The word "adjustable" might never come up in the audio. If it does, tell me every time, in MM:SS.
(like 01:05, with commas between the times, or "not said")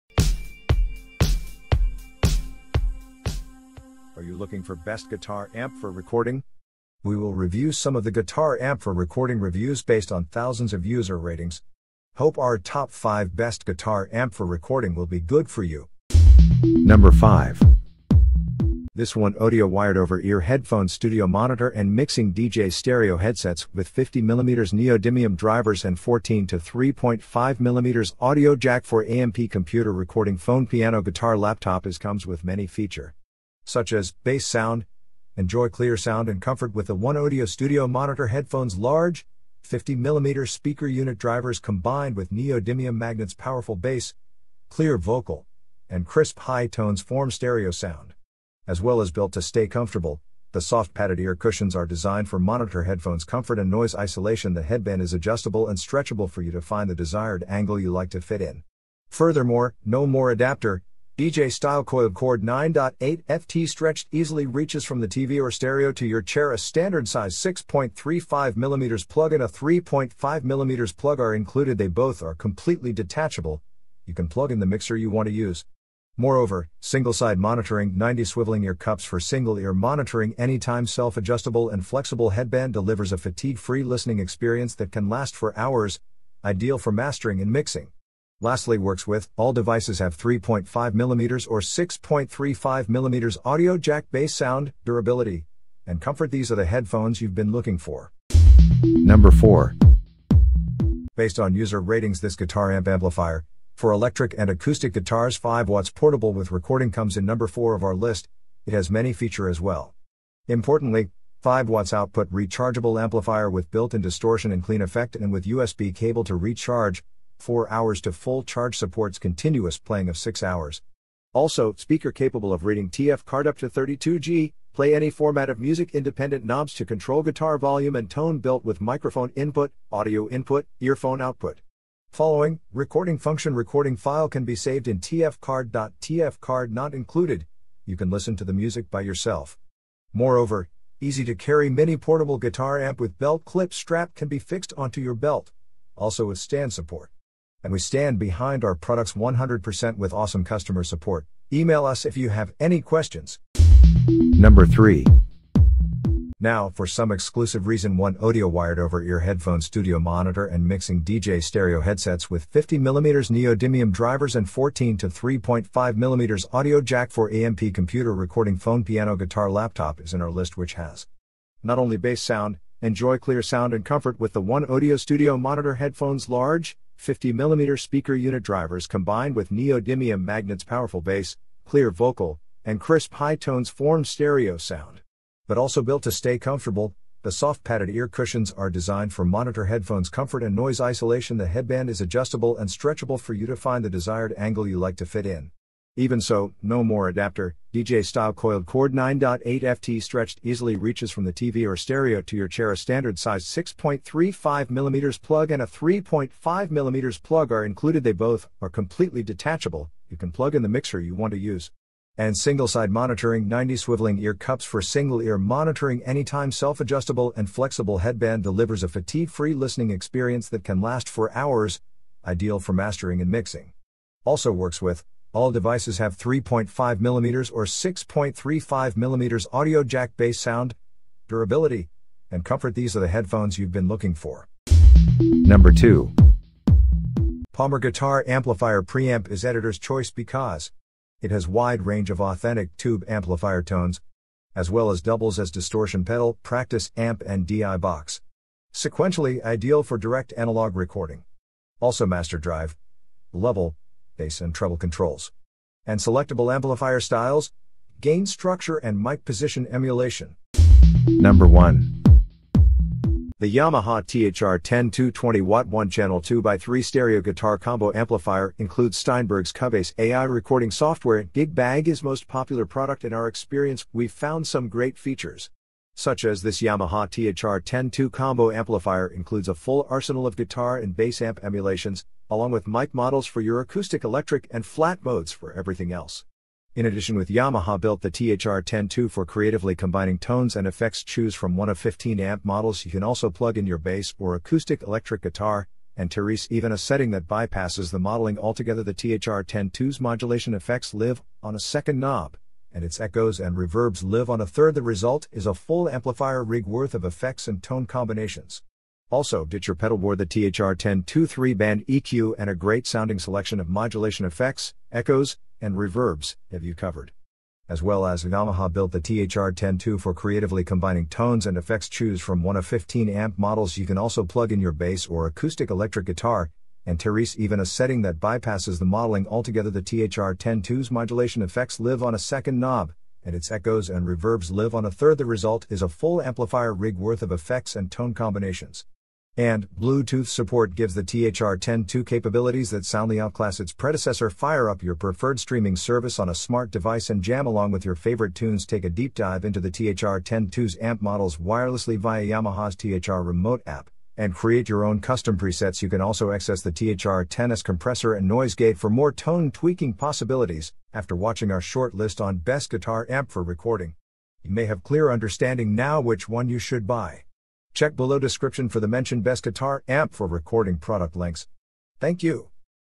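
00:55, 01:21, 03:12, 03:36.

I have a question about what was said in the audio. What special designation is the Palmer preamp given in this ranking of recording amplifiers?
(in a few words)
Editor's choice.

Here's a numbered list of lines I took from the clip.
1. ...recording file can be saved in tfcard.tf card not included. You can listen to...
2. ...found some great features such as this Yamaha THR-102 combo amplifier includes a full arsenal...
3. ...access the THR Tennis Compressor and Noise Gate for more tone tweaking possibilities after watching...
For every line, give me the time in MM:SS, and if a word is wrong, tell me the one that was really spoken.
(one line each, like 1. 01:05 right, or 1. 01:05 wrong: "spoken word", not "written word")
1. 02:13 right
2. 04:34 right
3. 05:56 right.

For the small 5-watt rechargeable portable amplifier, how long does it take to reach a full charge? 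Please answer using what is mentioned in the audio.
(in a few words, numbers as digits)
4 hours.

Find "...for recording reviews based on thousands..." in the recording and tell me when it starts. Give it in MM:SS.
00:08.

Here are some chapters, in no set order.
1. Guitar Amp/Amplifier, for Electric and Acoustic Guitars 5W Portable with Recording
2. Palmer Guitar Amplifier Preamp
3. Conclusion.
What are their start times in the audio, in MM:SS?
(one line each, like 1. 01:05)
1. 01:37
2. 03:51
3. 05:55.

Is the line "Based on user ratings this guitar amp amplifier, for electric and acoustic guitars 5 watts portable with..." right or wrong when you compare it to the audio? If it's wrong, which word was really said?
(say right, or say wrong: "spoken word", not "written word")
right.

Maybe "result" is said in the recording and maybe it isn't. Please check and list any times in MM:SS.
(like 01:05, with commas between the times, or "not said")
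05:04, 05:35.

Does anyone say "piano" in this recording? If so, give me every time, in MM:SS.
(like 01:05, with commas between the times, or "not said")
00:30, 02:48.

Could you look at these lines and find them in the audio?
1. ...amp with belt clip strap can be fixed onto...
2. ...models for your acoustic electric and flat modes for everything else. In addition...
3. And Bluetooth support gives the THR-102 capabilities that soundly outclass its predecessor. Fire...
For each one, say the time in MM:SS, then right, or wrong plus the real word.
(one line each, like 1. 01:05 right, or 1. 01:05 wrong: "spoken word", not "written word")
1. 02:22 right
2. 04:42 right
3. 05:39 right.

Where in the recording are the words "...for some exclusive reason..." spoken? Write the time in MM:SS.
02:36.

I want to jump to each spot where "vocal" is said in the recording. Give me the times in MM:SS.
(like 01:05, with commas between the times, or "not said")
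00:44, 03:01.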